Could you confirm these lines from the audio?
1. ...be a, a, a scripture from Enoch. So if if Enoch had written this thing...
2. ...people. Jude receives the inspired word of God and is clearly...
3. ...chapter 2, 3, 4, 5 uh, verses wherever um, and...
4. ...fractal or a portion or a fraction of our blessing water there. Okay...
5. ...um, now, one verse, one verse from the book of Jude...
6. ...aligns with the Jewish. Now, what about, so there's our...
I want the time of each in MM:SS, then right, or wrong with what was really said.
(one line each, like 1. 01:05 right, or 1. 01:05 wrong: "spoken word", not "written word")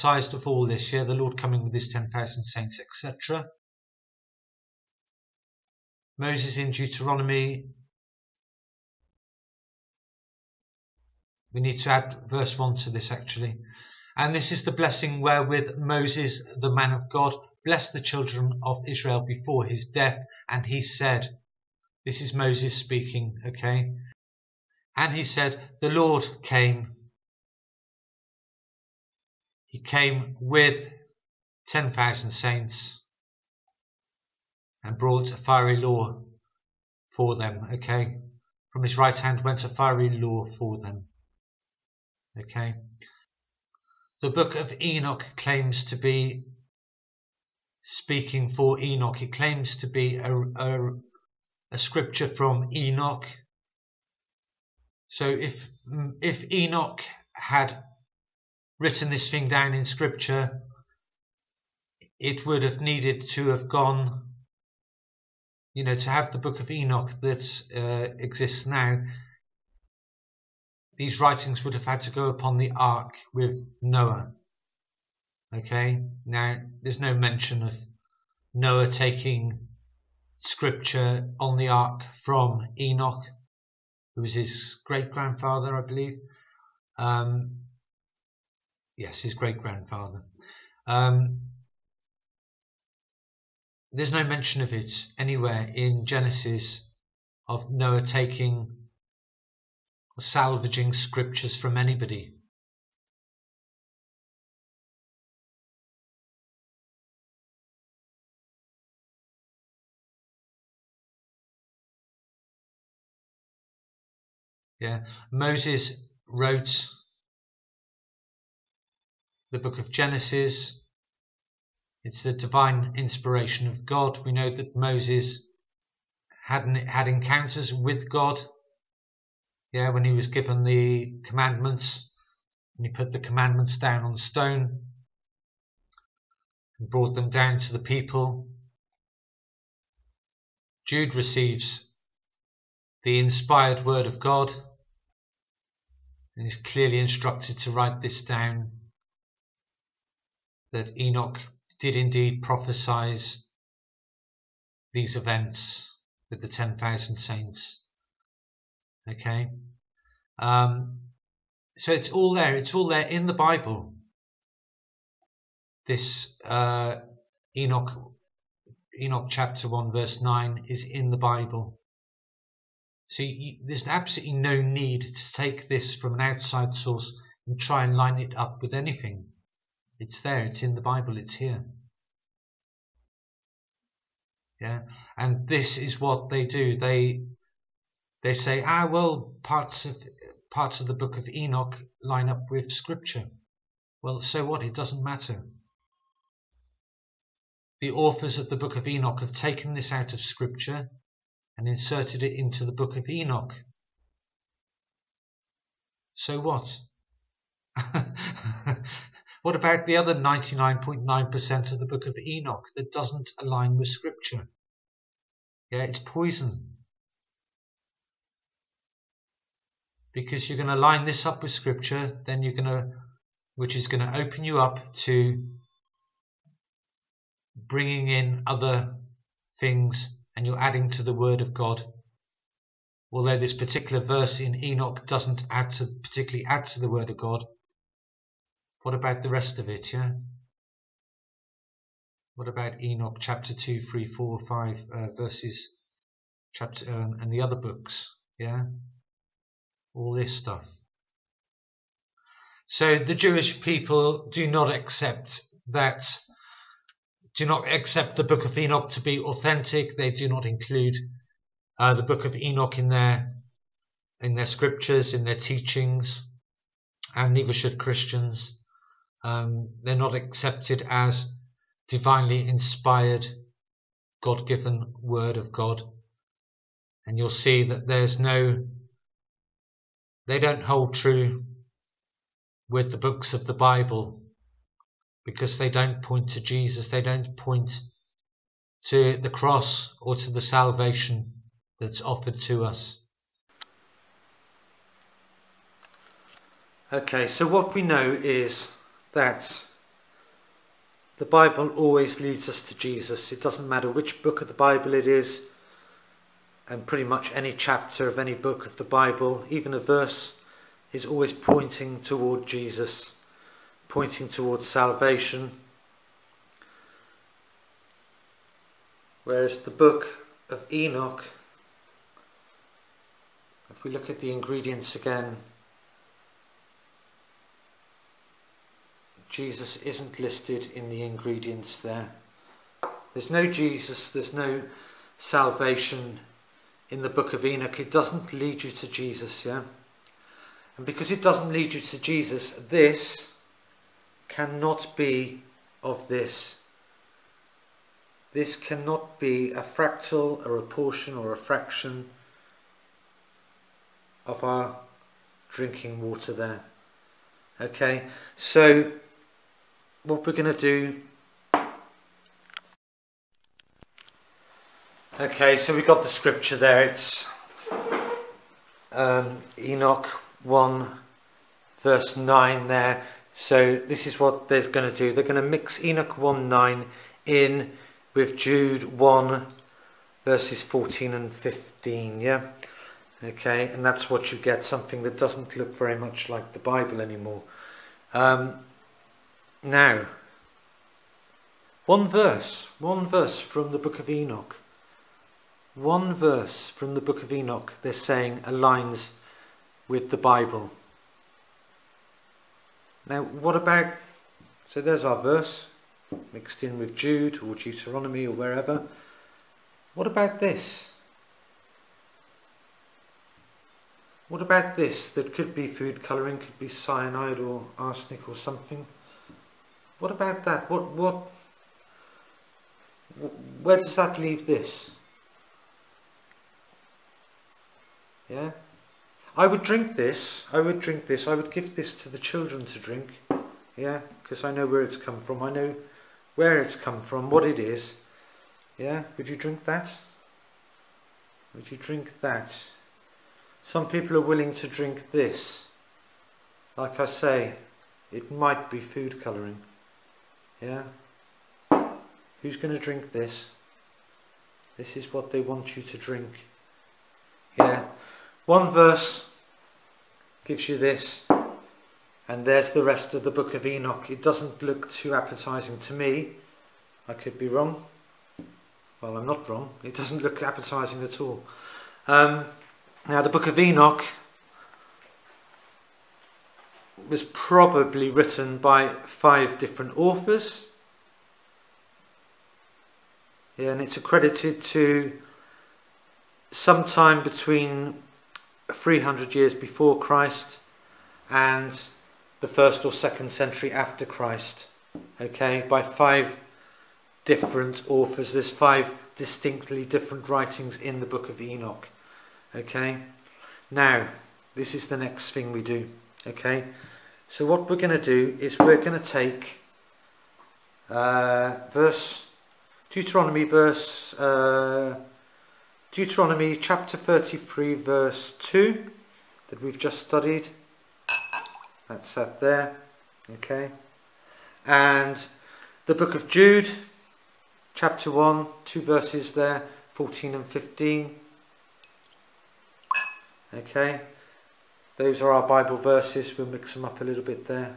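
1. 00:49 right
2. 02:17 right
3. 04:03 wrong: "chapter", not "wherever"
4. 05:49 wrong: "drinking", not "blessing"
5. 06:28 wrong: "Enoch", not "Jude"
6. 06:38 wrong: "Bible", not "Jewish".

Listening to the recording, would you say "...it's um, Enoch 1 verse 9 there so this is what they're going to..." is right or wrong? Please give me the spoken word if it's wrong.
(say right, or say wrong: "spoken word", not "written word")
right.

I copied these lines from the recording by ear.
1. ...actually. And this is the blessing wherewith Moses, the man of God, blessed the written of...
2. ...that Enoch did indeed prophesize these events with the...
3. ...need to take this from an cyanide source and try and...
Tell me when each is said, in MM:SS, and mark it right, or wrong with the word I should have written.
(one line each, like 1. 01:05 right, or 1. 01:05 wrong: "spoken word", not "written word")
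1. 00:13 wrong: "children", not "written"
2. 02:30 right
3. 02:54 wrong: "outside", not "cyanide".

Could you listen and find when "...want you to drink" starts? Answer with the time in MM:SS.
07:35.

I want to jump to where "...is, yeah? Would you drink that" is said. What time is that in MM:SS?
07:17.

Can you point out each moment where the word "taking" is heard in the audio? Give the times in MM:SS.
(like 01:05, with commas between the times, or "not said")
01:18, 01:38.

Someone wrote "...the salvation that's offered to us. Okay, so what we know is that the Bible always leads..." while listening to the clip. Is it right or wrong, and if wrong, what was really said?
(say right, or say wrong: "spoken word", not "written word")
right.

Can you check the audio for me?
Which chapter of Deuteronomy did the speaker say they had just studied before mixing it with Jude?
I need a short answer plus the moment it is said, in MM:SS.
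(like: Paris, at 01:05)
33, at 08:36.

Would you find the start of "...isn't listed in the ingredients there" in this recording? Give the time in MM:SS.
05:29.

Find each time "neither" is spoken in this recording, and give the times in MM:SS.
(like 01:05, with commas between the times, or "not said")
04:27.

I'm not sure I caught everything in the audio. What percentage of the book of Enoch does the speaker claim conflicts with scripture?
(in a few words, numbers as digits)
99.9%.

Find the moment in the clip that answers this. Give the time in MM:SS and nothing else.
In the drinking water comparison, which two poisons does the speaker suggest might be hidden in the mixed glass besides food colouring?
06:56.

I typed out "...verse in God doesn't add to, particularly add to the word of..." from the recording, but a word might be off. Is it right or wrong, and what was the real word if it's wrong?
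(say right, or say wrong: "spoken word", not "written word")
wrong: "Enoch", not "God".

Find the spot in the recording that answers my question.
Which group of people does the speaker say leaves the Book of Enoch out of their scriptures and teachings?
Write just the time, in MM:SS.
04:12.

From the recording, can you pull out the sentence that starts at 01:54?
Yeah, Moses wrote the book of Genesis.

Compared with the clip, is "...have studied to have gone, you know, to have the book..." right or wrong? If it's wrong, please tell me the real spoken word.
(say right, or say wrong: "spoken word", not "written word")
wrong: "needed", not "studied".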